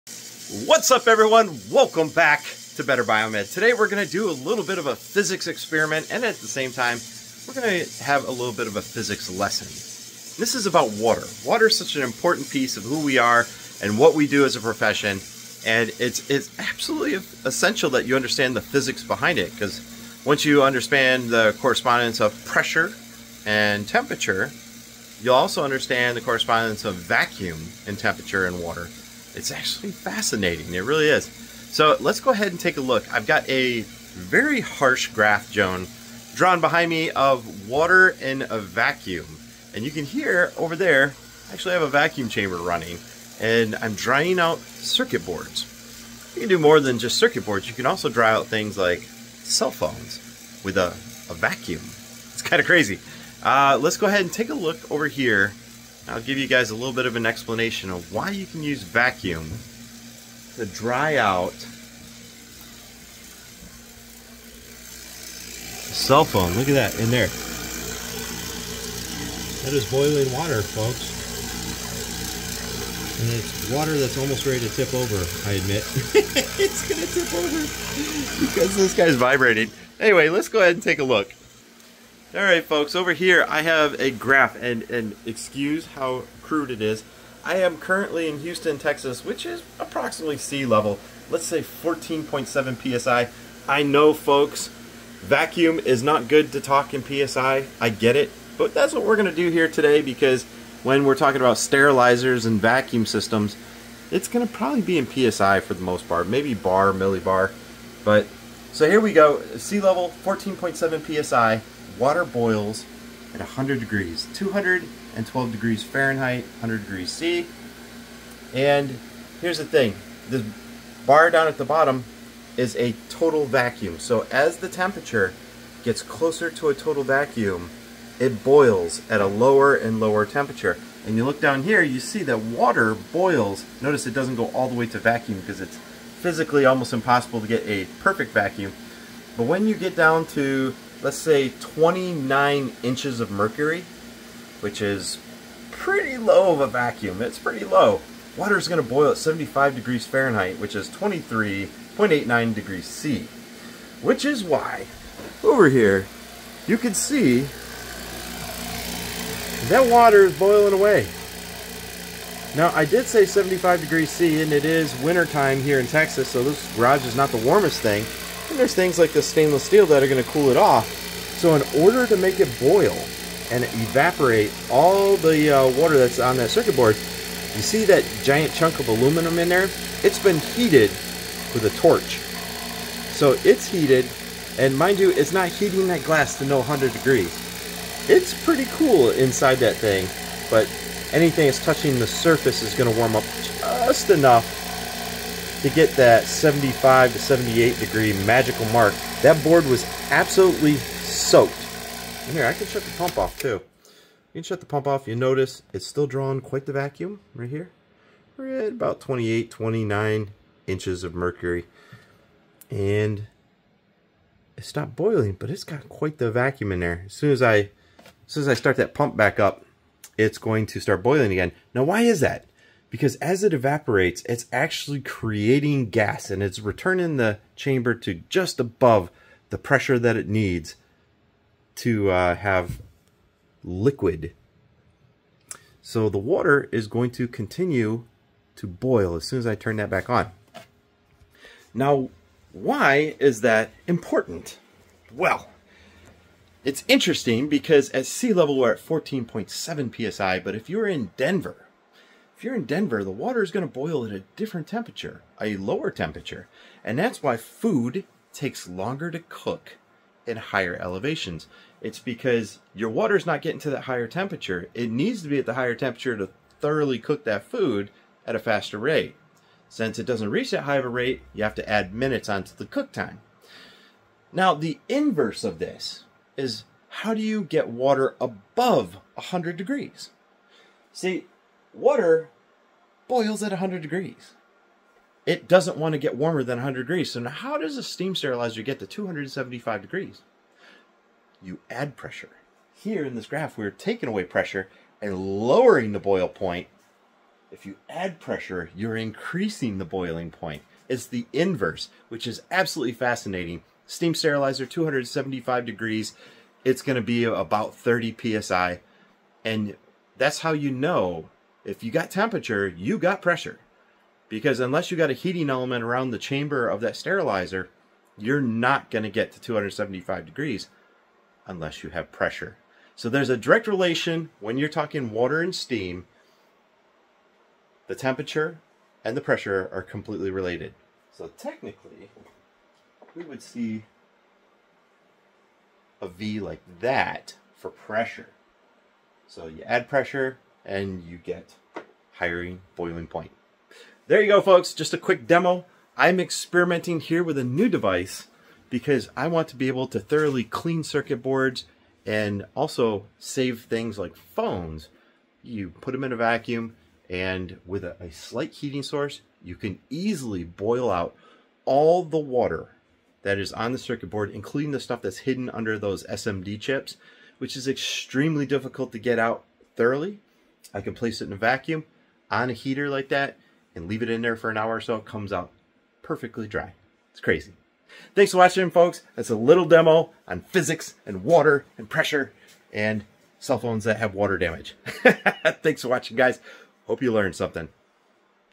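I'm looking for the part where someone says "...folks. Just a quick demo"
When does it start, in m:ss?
5:44.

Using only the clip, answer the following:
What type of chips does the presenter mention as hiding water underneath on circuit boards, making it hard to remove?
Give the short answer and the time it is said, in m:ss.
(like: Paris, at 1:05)
SMD chips, at 6:06.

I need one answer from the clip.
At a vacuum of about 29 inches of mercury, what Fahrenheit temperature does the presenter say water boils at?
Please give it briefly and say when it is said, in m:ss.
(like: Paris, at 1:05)
75 degrees Fahrenheit, at 2:29.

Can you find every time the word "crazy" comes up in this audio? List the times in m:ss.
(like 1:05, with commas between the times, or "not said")
0:52, 6:17.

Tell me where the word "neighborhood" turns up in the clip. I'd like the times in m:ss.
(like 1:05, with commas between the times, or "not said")
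not said.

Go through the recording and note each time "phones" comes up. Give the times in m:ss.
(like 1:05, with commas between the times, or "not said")
0:49, 1:06, 5:54, 6:23.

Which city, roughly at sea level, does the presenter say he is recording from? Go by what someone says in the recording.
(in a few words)
Houston, Texas.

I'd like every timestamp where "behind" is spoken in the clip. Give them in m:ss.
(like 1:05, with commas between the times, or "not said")
0:19, 0:36.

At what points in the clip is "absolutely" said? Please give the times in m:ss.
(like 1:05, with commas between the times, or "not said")
0:16, 3:20, 5:02.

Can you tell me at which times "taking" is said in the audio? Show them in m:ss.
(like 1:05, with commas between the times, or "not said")
4:53.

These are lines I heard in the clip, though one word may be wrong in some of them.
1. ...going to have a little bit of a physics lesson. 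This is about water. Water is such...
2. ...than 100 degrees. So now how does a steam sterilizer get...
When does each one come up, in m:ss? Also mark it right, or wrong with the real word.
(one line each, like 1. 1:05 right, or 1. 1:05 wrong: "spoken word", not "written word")
1. 0:07 right
2. 4:46 right.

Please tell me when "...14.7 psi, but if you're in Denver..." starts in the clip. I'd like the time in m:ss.
4:08.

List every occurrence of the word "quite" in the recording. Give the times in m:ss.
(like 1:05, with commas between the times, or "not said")
3:26, 3:35.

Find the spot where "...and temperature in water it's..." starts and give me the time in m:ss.
0:27.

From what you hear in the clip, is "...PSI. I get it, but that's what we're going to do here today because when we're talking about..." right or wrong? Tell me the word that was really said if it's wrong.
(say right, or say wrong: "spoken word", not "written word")
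right.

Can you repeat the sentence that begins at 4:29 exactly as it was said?
Since it doesn't reach that high of a rate, you have to add minutes onto the cook time.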